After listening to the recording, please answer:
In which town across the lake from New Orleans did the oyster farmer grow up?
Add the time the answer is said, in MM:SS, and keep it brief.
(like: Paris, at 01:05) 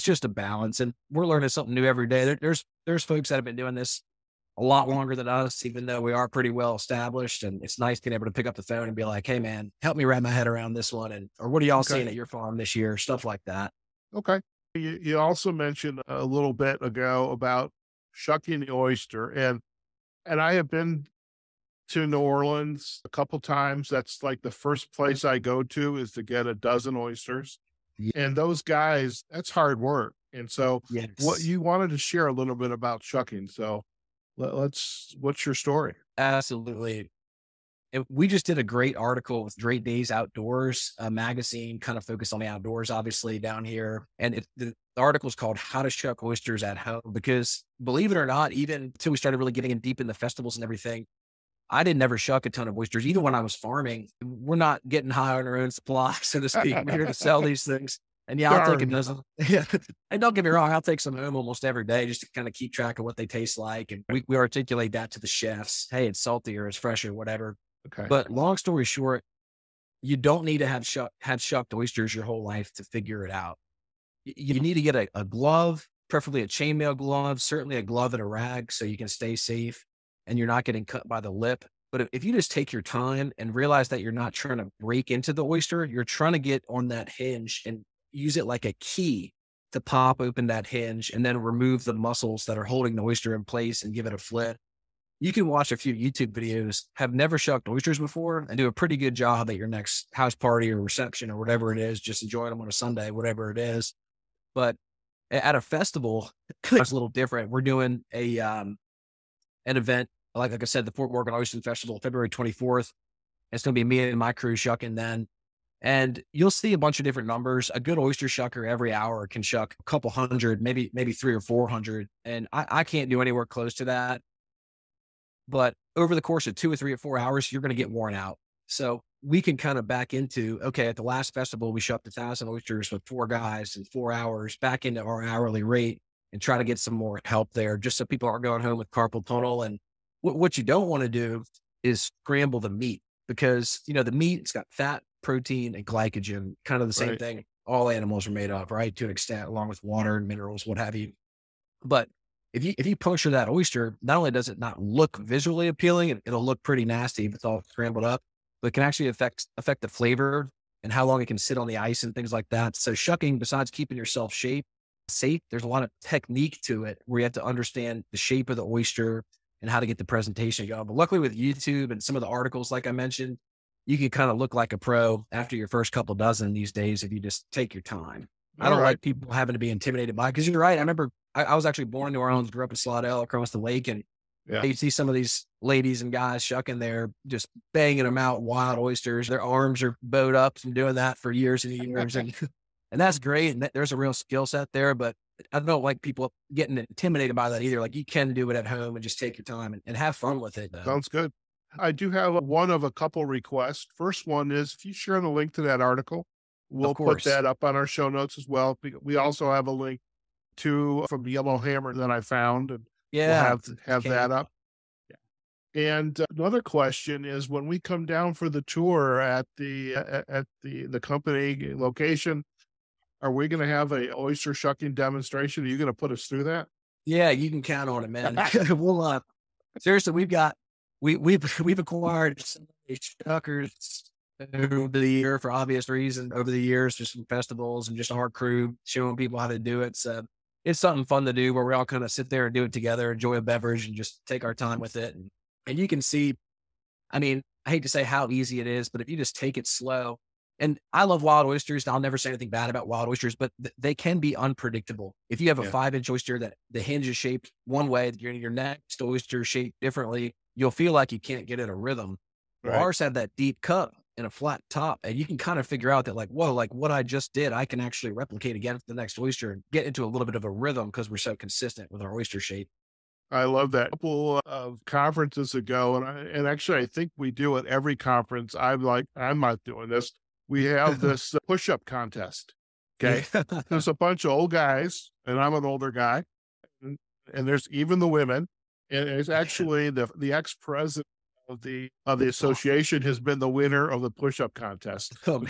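Slidell, at 03:02.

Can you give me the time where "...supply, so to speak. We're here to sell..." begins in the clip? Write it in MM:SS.
00:55.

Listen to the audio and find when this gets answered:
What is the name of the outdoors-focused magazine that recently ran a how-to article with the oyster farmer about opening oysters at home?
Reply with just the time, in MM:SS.
00:39.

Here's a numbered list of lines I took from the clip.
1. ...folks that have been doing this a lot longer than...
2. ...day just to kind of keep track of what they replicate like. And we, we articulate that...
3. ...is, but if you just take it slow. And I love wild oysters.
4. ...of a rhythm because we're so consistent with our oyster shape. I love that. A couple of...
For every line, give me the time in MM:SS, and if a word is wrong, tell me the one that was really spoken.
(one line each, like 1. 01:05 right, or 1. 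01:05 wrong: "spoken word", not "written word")
1. 00:03 right
2. 01:01 wrong: "taste", not "replicate"
3. 04:08 right
4. 04:30 right.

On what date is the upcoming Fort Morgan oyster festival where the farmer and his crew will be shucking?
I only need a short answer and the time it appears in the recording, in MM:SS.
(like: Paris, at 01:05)
February 24th, at 01:52.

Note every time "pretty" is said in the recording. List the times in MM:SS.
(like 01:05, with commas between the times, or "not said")
00:06, 01:38, 02:36.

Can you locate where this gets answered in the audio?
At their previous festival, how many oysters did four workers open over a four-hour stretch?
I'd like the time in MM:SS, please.
02:12.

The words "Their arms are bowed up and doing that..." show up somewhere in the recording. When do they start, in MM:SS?
03:09.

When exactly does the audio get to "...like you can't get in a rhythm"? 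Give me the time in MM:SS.
04:20.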